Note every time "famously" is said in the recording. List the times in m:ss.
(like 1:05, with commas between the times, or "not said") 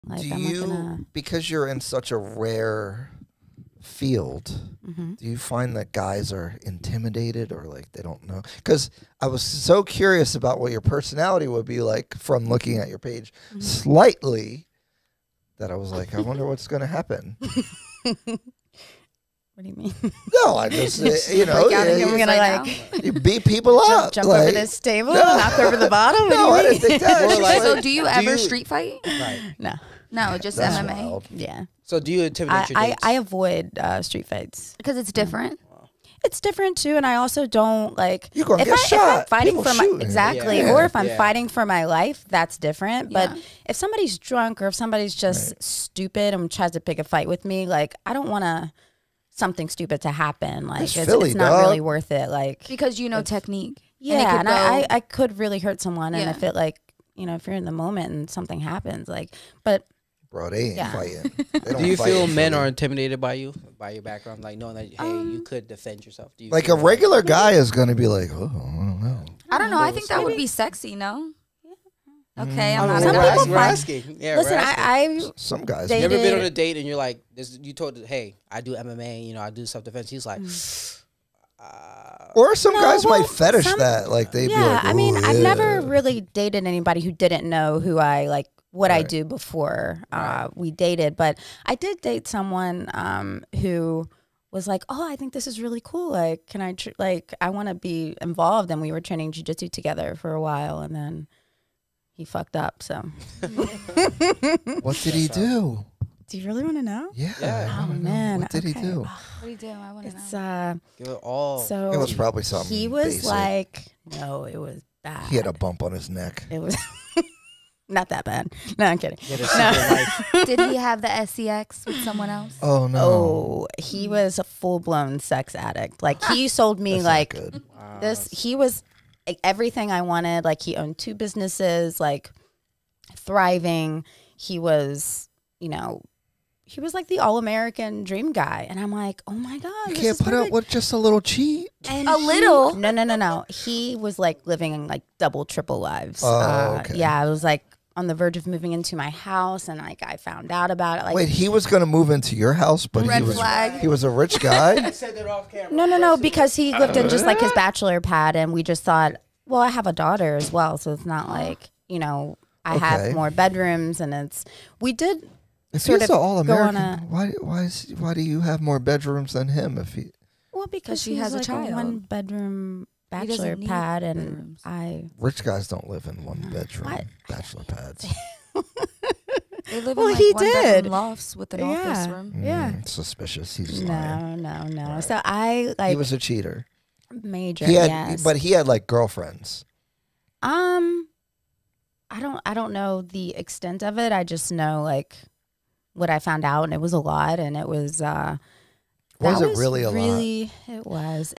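not said.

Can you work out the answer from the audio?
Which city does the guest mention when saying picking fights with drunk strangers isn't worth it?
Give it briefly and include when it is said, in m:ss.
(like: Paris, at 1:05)
Philly, at 0:50.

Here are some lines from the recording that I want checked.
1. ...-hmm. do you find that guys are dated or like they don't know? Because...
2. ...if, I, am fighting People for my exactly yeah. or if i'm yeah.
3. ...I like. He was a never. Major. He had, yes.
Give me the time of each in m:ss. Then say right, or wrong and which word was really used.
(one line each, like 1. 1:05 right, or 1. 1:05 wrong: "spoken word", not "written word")
1. 0:04 wrong: "intimidated", not "dated"
2. 0:38 right
3. 3:05 wrong: "cheater", not "never".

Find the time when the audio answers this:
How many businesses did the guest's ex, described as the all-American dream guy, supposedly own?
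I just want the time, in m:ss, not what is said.
2:10.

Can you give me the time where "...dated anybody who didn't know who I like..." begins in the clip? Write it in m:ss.
1:26.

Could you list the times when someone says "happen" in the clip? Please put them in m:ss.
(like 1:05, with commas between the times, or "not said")
0:16, 0:50, 0:58.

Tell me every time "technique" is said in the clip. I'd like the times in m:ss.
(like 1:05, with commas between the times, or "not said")
0:53.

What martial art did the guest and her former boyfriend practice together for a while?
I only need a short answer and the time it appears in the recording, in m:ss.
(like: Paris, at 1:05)
Jujitsu, at 1:39.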